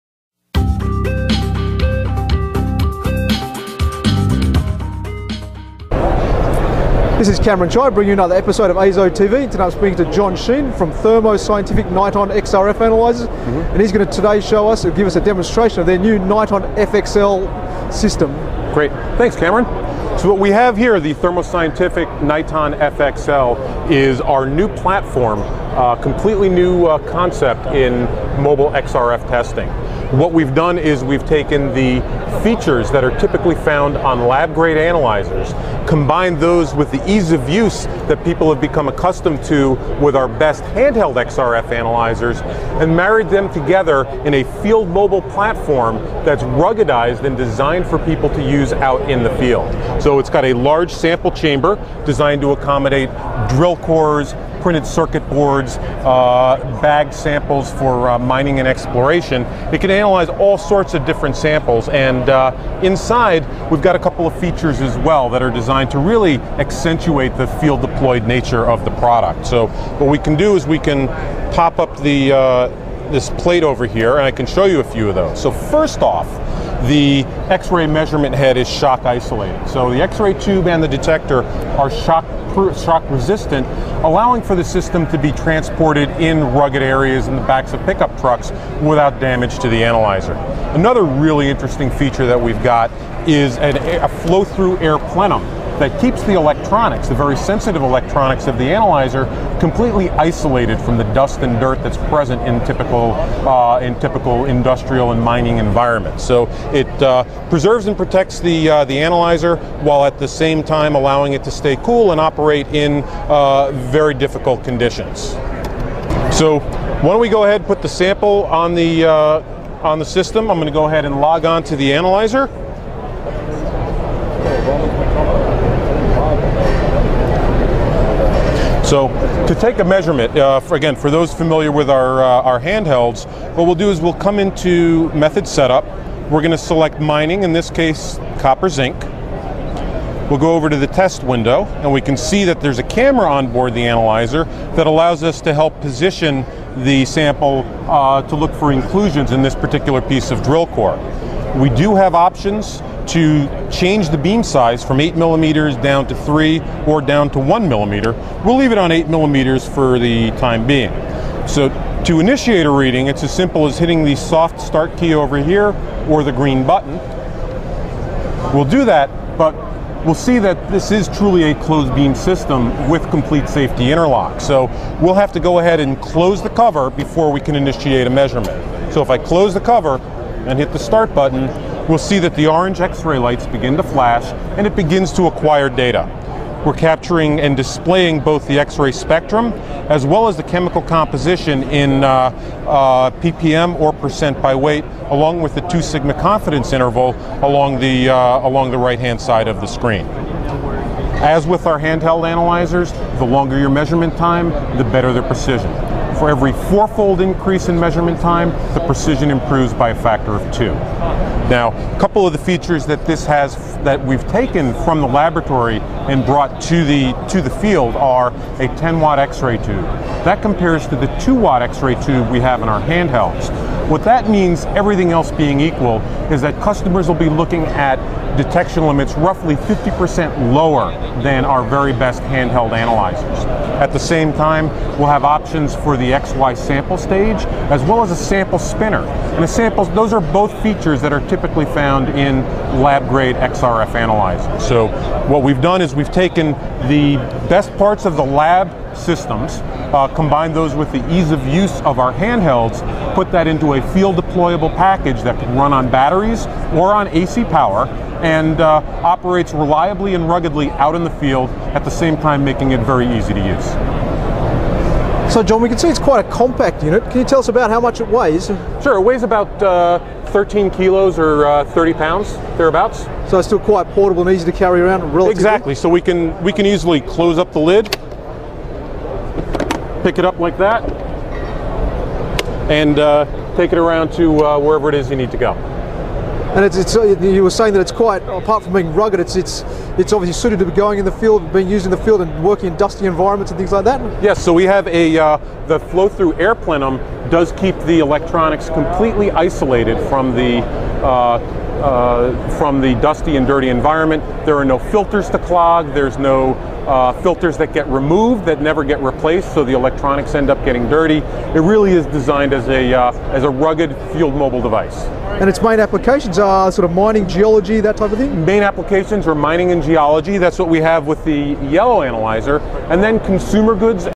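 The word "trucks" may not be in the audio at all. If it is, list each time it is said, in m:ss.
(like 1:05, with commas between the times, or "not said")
1:28.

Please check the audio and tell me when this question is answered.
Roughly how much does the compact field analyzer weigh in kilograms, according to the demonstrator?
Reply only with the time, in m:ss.
4:30.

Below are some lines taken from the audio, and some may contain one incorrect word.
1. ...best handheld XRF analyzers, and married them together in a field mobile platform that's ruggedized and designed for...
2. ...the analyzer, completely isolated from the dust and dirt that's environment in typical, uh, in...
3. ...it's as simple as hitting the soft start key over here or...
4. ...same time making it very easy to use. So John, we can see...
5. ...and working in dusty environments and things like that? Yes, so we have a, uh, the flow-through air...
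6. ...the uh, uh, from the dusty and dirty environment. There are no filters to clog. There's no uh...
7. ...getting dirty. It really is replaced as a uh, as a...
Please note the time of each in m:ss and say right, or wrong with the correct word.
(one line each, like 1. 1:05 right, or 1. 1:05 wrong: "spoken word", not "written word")
1. 0:40 right
2. 1:38 wrong: "present", not "environment"
3. 2:43 right
4. 4:21 right
5. 4:52 right
6. 5:00 right
7. 5:10 wrong: "designed", not "replaced".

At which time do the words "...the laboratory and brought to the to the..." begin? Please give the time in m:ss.
3:35.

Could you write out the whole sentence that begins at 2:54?
So we'll have to go ahead and close the cover before we can initiate a measurement.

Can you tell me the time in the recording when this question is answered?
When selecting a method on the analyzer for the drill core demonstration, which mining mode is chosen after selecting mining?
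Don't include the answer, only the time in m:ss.
2:18.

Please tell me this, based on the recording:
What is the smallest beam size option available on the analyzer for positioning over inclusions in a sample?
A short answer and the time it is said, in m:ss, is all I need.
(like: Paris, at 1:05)
1 millimeter, at 2:37.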